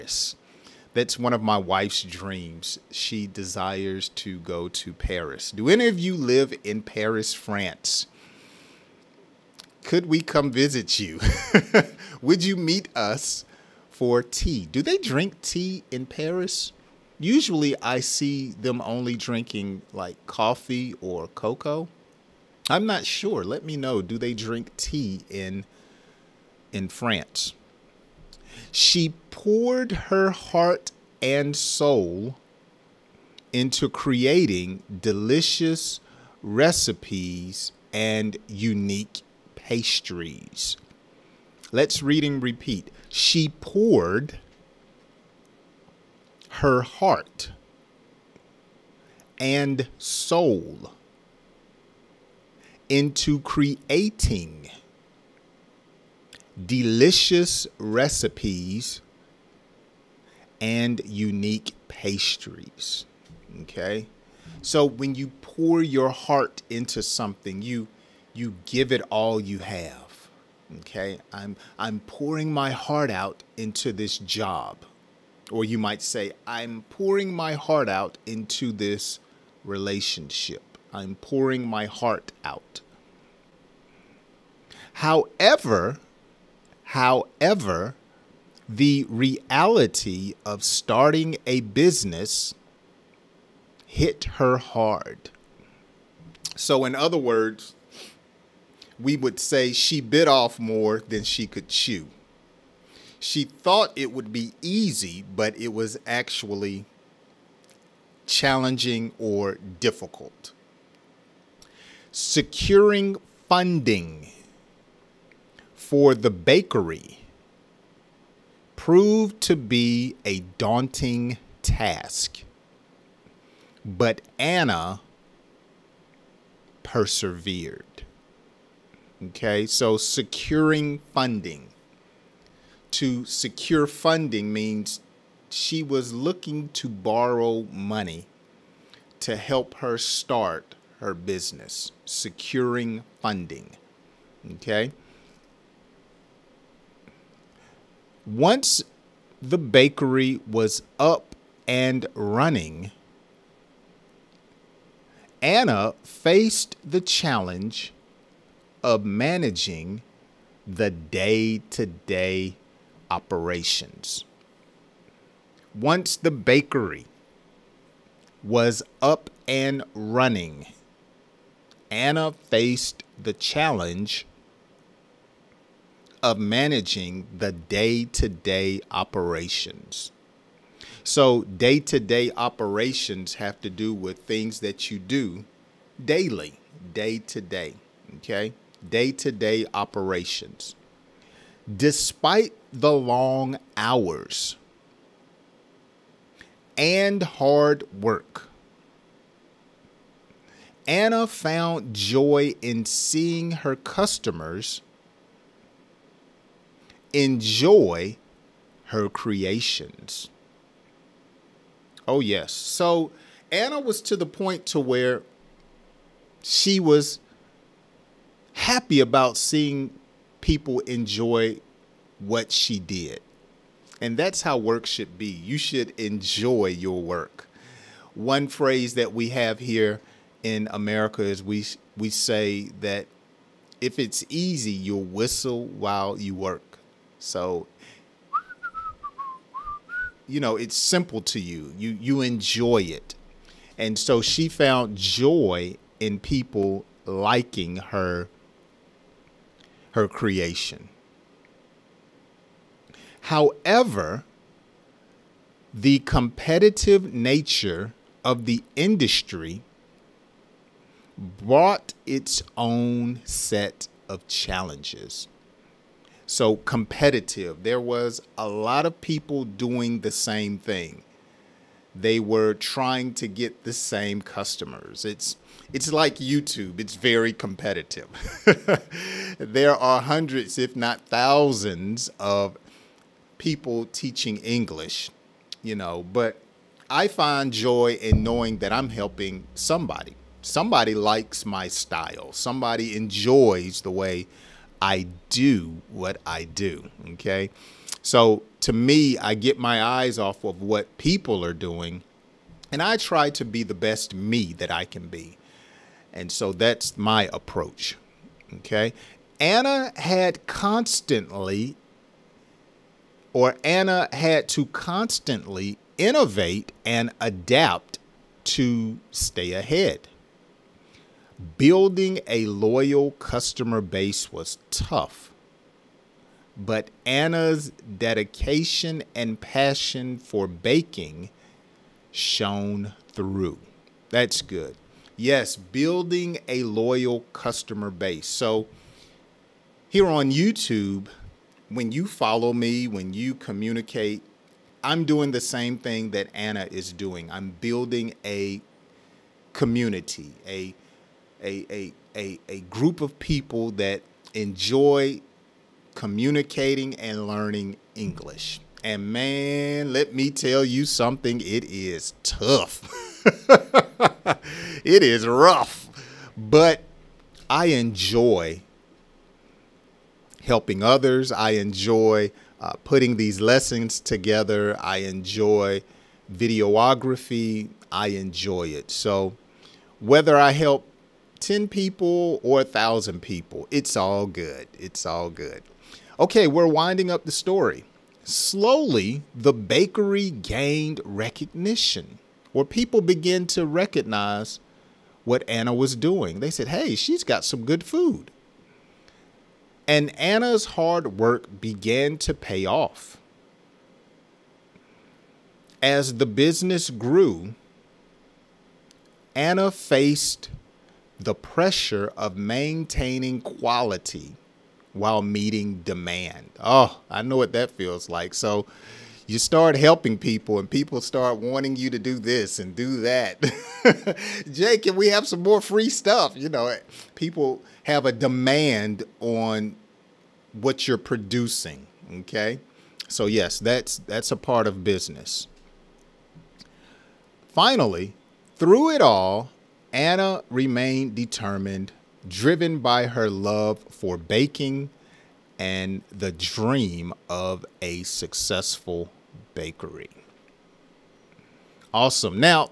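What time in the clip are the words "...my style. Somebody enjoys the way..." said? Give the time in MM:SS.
04:51.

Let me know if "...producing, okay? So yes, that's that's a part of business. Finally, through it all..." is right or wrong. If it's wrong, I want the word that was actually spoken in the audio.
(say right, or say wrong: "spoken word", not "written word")
right.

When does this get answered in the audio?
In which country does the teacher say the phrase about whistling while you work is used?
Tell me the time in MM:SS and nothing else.
03:50.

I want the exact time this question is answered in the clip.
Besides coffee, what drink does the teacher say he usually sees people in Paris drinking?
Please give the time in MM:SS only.
00:21.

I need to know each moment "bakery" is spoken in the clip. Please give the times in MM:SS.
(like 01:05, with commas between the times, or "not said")
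01:56, 02:29, 02:46, 06:29, 07:29.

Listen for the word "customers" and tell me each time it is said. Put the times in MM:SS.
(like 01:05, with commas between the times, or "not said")
03:23, 04:34, 05:23, 05:37.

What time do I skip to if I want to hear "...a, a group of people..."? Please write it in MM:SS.
05:52.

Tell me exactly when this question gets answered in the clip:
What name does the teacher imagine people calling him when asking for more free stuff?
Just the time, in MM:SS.
07:04.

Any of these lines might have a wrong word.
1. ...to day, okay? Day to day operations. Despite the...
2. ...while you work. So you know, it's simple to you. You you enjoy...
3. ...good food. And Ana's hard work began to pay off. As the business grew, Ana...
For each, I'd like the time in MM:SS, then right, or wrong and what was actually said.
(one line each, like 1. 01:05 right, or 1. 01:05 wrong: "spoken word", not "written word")
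1. 03:07 right
2. 03:55 right
3. 06:37 right.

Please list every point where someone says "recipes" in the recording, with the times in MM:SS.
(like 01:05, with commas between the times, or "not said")
00:36, 00:57.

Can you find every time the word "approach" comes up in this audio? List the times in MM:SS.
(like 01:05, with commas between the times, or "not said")
05:07.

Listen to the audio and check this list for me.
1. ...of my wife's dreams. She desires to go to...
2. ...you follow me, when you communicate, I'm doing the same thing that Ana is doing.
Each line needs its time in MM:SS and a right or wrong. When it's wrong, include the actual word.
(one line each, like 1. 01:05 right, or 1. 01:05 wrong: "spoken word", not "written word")
1. 00:01 right
2. 05:41 right.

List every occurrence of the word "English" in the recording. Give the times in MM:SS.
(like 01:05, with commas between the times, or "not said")
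04:44, 05:57.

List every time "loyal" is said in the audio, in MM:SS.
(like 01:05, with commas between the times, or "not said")
05:22, 05:36.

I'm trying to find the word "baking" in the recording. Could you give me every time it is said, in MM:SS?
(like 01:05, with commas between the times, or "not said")
05:30, 07:24.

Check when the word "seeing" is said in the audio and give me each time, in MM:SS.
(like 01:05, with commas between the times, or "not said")
03:22, 03:39.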